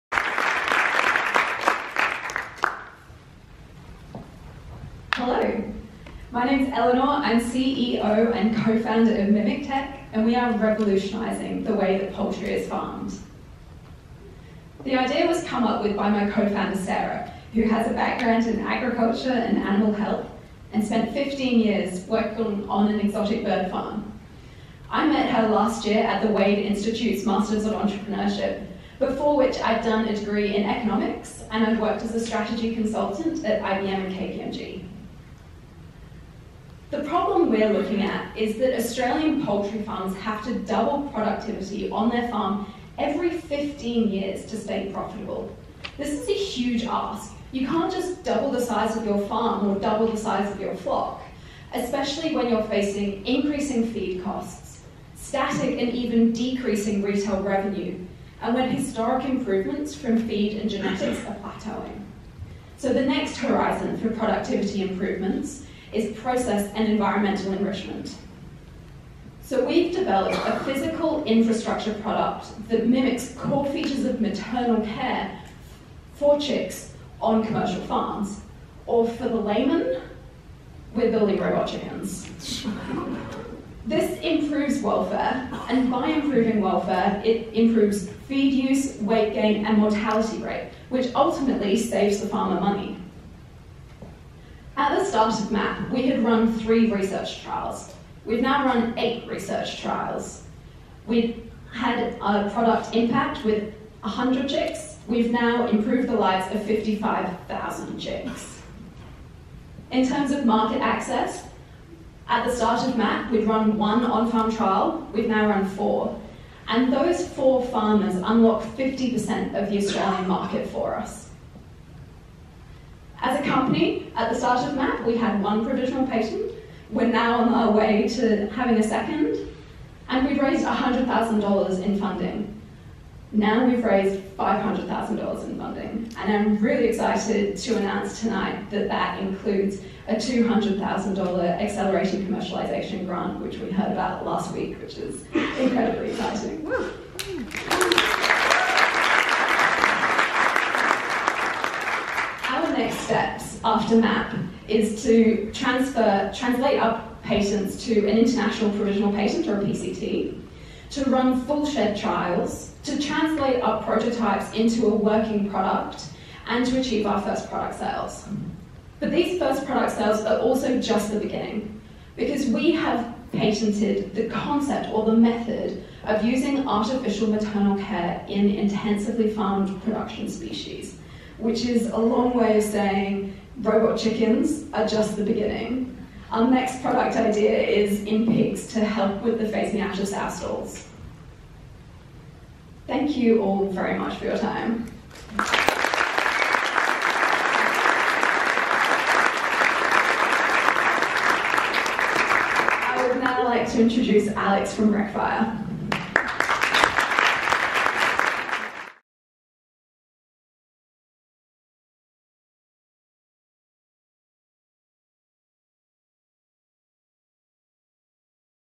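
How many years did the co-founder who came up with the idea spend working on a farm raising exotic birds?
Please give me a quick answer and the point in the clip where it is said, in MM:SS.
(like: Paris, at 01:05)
15 years, at 00:21.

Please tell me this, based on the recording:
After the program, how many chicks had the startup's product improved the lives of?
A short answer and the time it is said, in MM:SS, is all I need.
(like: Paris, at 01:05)
55,000, at 01:46.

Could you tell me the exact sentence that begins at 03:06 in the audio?
Our next product idea is in pigs to help with the phase meiosis sow stalls.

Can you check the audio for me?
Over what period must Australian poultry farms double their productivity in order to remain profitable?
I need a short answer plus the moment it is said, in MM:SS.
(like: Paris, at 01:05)
15 years, at 00:42.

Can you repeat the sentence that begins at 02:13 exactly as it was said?
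Now we've raised $500,000 in funding.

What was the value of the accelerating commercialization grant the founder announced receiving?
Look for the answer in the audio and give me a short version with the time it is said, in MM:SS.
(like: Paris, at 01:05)
$200,000, at 02:20.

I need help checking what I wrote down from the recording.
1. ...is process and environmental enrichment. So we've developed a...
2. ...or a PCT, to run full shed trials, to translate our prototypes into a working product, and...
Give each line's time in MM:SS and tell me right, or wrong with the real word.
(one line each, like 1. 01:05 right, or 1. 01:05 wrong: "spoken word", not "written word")
1. 01:05 right
2. 02:39 right.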